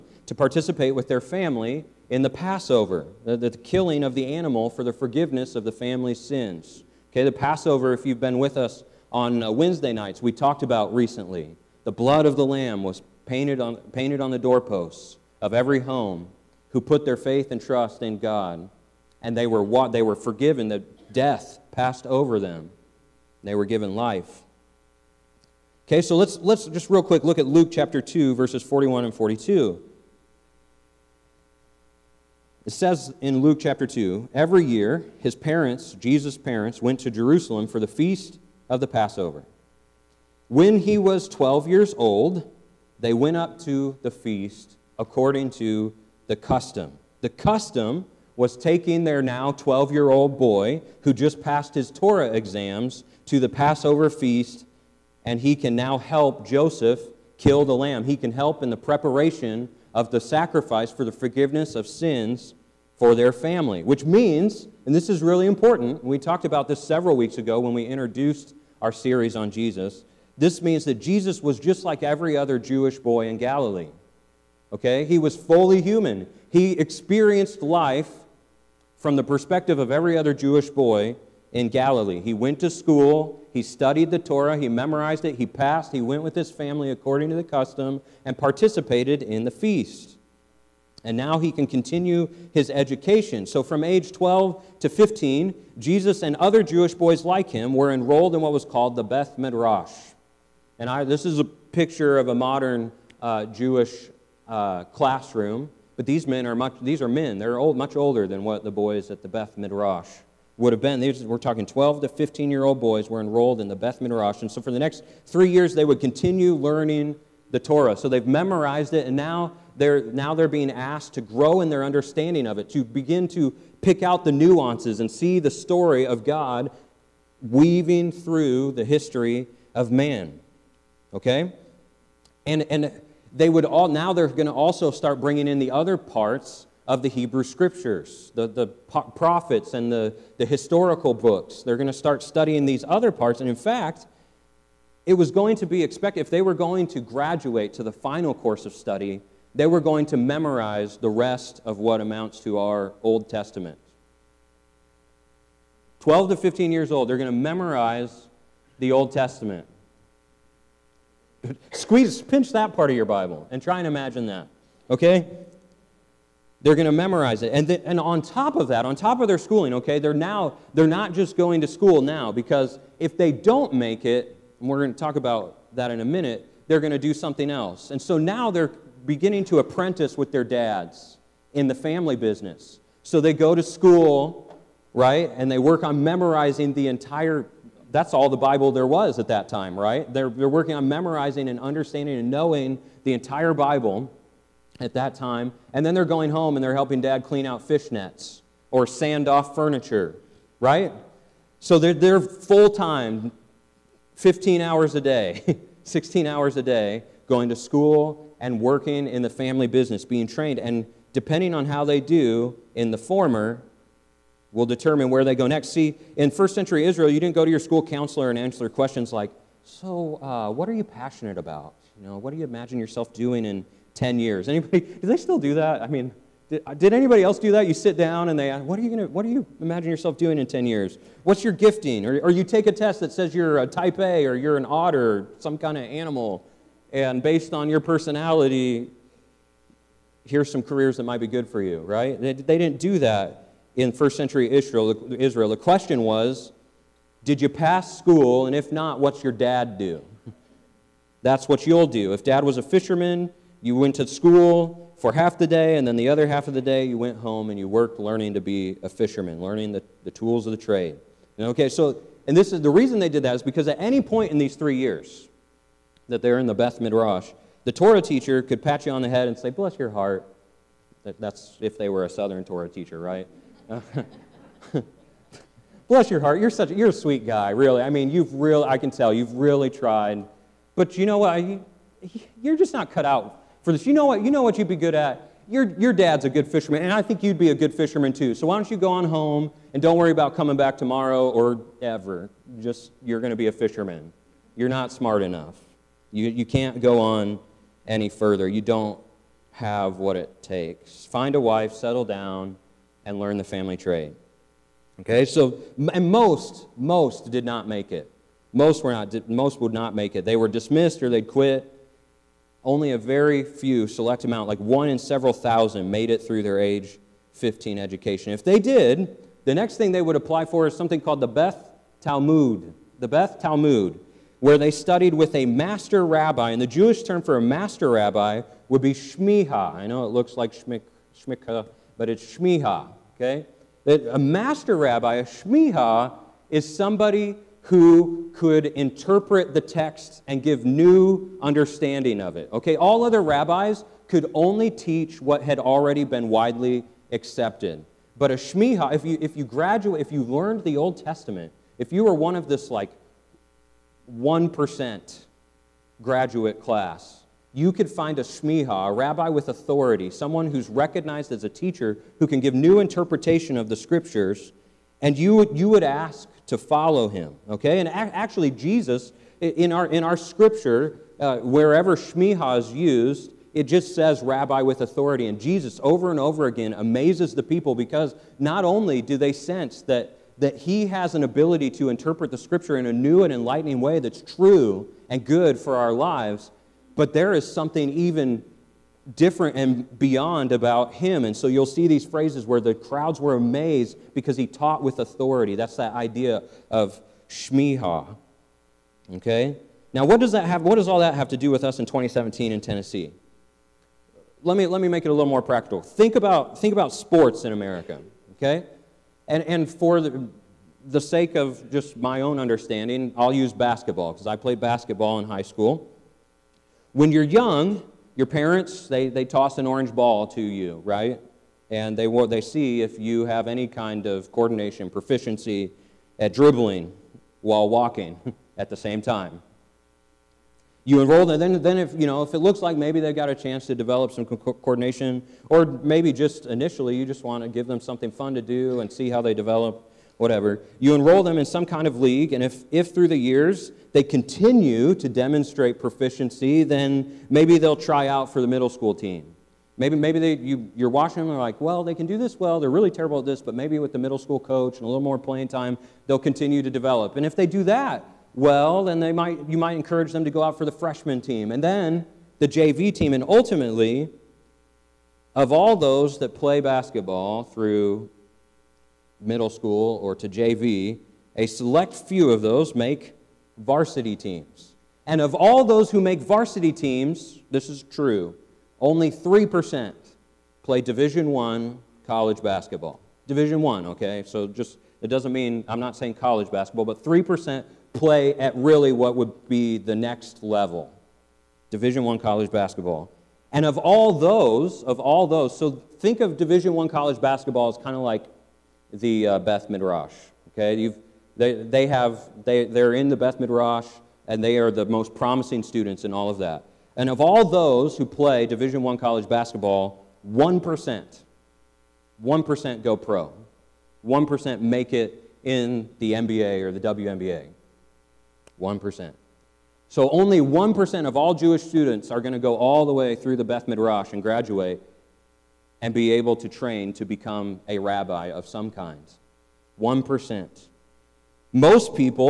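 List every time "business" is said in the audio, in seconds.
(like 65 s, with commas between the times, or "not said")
182 s, 209 s.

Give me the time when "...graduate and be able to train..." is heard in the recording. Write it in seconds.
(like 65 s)
524 s.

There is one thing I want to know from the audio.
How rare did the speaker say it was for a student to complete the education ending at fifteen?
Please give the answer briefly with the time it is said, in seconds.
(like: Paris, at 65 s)
one in several thousand, at 314 s.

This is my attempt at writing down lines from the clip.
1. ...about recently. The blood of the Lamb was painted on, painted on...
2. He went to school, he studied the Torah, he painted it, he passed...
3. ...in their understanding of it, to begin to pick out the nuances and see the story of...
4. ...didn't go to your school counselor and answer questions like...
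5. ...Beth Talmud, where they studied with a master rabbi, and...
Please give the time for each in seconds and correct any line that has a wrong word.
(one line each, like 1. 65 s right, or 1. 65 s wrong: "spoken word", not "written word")
1. 10 s right
2. 82 s wrong: "memorized", not "painted"
3. 121 s right
4. 217 s right
5. 323 s right.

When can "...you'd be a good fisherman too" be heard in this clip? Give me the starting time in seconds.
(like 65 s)
287 s.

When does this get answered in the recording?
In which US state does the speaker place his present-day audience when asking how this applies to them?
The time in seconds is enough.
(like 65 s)
402 s.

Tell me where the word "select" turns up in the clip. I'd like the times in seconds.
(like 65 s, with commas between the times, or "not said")
313 s, 471 s.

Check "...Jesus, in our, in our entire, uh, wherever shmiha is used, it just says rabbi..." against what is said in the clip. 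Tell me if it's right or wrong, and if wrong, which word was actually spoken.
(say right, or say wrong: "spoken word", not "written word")
wrong: "scripture", not "entire".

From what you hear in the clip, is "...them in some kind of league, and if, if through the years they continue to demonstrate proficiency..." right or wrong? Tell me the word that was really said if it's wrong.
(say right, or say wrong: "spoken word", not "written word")
right.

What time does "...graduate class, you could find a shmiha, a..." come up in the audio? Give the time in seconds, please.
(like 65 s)
356 s.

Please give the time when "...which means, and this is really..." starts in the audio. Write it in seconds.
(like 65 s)
63 s.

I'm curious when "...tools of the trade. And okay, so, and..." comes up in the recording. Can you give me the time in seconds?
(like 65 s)
260 s.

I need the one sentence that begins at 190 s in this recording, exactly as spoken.
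They're, they're working on memorizing and understanding and knowing the entire Bible at that time.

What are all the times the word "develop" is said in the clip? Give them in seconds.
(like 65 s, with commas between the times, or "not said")
433 s, 439 s, 456 s.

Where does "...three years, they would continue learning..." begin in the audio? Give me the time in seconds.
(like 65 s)
115 s.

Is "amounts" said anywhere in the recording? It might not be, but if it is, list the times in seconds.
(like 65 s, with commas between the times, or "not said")
152 s, 314 s.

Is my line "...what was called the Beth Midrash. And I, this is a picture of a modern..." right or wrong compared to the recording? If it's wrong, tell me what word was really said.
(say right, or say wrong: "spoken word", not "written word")
right.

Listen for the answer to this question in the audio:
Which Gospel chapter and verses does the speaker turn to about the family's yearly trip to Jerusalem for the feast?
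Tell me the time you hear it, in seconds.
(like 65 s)
27 s.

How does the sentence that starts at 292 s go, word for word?
Just, you're going to be a fisherman.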